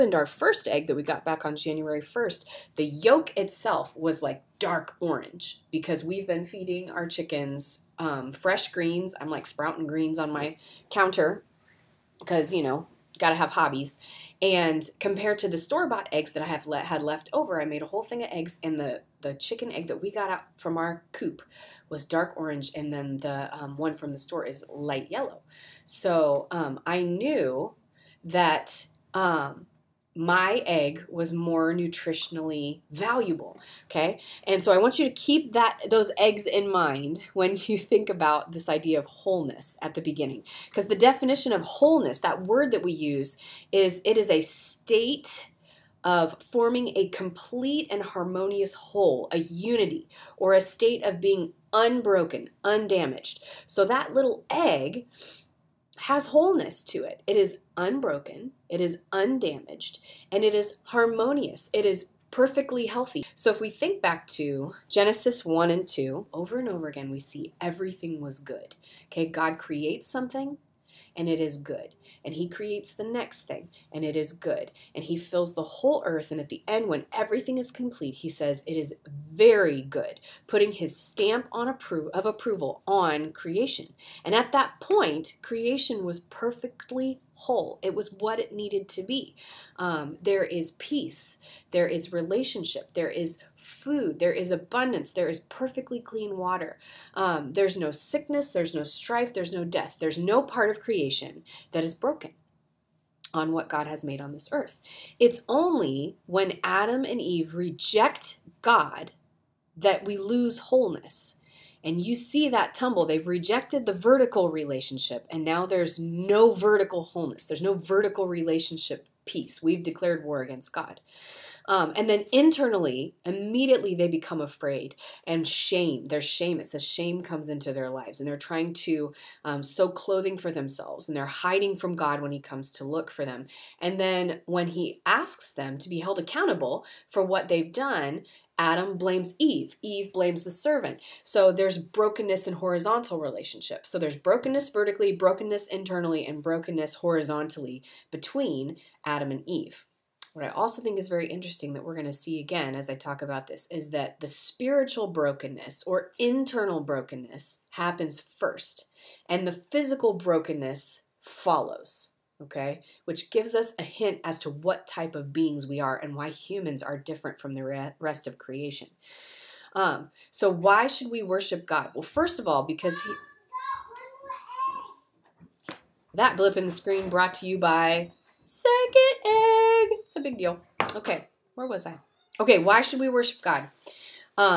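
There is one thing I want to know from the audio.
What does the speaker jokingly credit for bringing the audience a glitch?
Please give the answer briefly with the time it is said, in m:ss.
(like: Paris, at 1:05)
Second Egg, at 2:58.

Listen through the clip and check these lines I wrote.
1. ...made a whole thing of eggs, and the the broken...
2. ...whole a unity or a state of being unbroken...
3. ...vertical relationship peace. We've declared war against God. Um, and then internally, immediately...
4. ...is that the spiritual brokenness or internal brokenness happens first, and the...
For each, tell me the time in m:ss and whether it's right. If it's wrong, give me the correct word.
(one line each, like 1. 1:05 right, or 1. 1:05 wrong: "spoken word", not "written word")
1. 0:17 wrong: "chicken", not "broken"
2. 0:48 right
3. 1:57 right
4. 2:33 right.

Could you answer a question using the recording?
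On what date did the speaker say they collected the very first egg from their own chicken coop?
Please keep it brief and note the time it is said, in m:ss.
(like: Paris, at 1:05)
January 1st, at 0:01.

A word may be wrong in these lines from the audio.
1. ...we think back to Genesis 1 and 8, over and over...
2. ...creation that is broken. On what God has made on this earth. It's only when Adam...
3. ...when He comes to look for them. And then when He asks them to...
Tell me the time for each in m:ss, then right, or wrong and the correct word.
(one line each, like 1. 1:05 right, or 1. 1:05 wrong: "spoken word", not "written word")
1. 1:03 wrong: "2", not "8"
2. 1:40 right
3. 2:12 right.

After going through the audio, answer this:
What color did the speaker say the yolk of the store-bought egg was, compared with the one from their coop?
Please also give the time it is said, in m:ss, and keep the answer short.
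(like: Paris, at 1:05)
Light yellow, at 0:24.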